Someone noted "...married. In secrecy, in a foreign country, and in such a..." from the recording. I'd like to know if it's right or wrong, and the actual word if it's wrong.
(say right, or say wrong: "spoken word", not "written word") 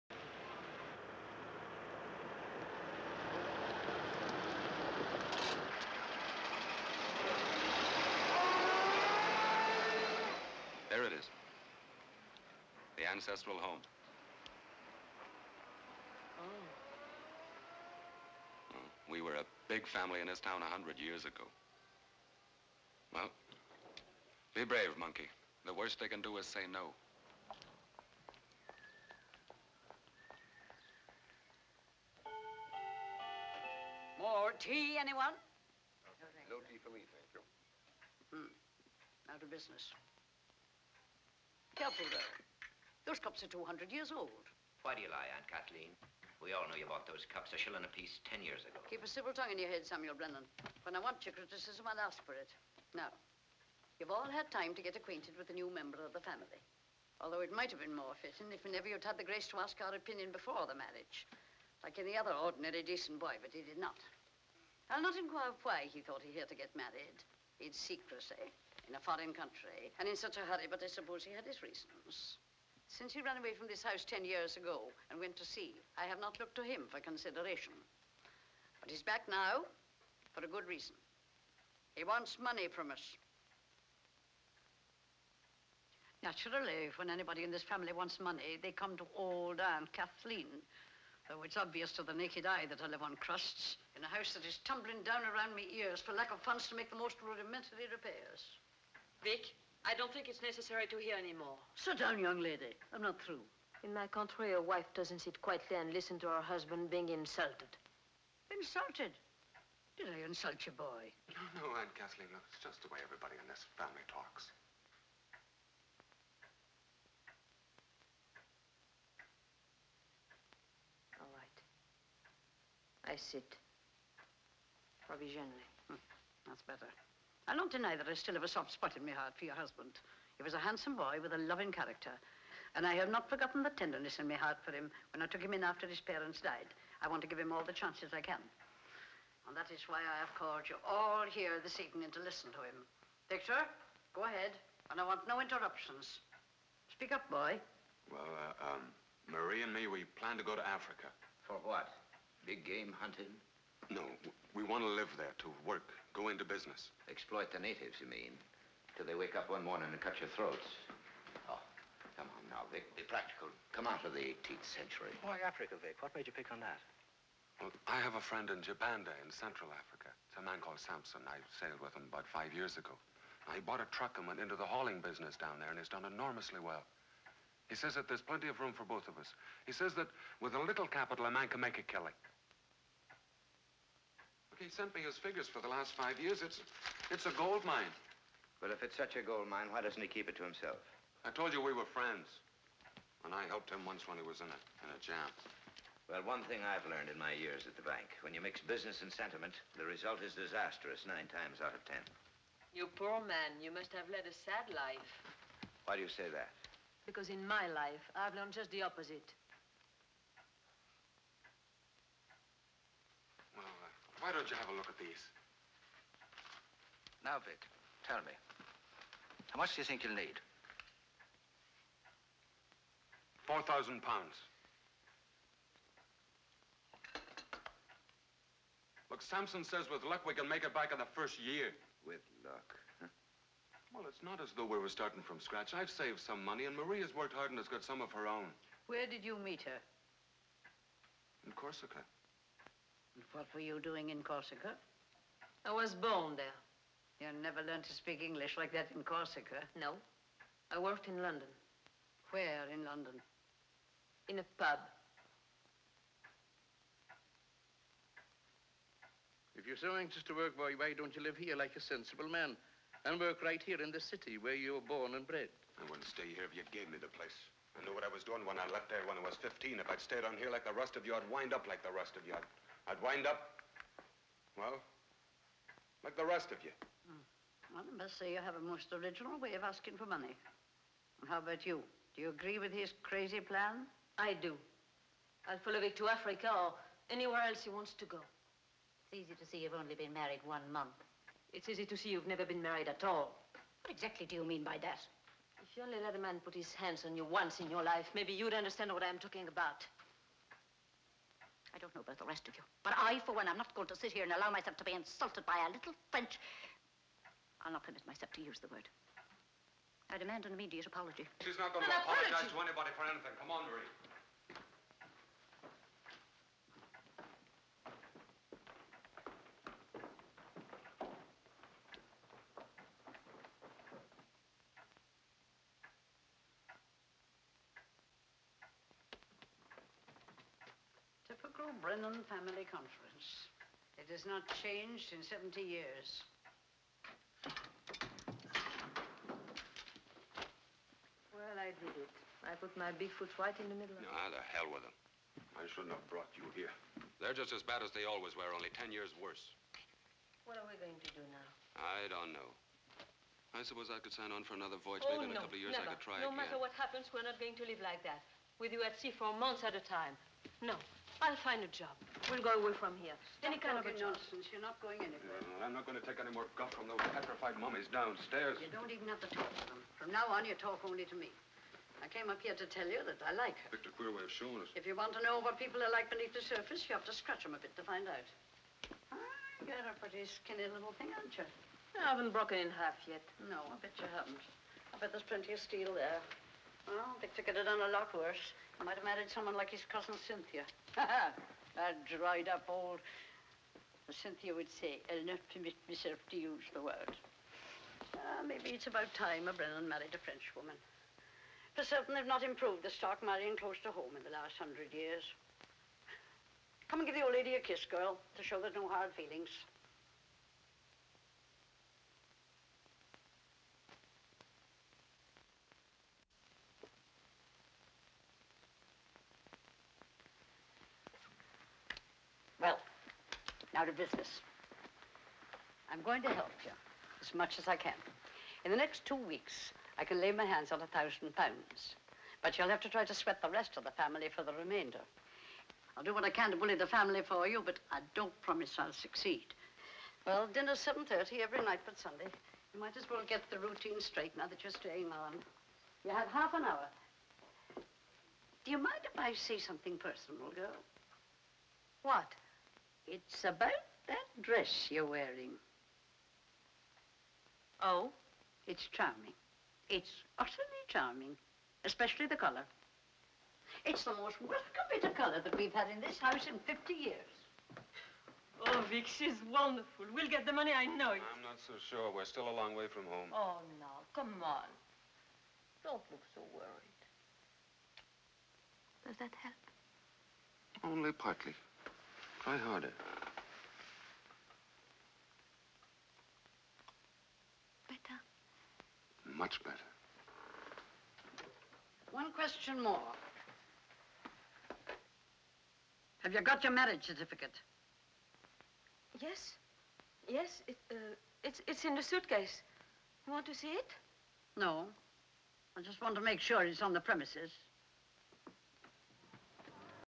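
right.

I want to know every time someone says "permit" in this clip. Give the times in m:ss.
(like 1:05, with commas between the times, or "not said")
5:07, 6:35.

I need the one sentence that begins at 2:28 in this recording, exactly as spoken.
Well, uh, um, Marie and me, we plan to go to Africa.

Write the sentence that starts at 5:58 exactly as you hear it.
With you at sea for months at a time.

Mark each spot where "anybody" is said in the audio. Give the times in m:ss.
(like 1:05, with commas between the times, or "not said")
1:27, 5:12.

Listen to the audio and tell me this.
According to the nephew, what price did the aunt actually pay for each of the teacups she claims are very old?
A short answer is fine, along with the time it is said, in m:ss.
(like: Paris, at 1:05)
A shilling, at 0:47.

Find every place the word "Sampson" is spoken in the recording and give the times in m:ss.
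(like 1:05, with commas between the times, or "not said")
2:50, 3:49.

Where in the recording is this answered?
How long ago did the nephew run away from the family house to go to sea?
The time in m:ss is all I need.
1:14.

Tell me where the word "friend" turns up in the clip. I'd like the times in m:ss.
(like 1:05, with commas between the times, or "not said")
2:48, 3:11.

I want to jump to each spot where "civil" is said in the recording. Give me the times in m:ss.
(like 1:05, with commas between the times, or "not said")
0:49.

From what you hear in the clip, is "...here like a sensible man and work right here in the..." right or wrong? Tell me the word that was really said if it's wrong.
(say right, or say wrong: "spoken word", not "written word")
right.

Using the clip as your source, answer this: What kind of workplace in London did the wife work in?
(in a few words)
A pub.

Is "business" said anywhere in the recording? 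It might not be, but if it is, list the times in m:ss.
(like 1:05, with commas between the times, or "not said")
0:39, 2:36, 2:55, 3:18, 7:03.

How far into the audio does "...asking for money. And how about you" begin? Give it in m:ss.
4:39.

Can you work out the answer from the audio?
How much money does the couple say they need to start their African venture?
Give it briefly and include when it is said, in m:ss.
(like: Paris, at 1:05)
4,000 pounds, at 3:43.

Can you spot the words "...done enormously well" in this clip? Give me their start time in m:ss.
2:55.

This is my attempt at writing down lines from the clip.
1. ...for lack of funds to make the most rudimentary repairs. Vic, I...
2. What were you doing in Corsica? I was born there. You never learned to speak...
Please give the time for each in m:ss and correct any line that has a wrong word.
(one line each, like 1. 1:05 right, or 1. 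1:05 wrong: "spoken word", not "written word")
1. 1:36 right
2. 4:03 right.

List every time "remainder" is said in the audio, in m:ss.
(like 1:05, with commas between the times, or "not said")
7:14.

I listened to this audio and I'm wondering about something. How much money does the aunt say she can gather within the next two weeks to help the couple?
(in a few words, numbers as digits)
A thousand pounds.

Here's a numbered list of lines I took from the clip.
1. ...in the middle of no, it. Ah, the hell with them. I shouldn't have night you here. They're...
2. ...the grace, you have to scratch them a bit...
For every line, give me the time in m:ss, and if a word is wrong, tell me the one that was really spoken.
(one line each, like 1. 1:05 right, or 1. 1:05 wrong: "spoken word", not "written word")
1. 5:43 wrong: "brought", not "night"
2. 6:16 wrong: "surface", not "grace".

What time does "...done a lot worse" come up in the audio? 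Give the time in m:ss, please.
6:27.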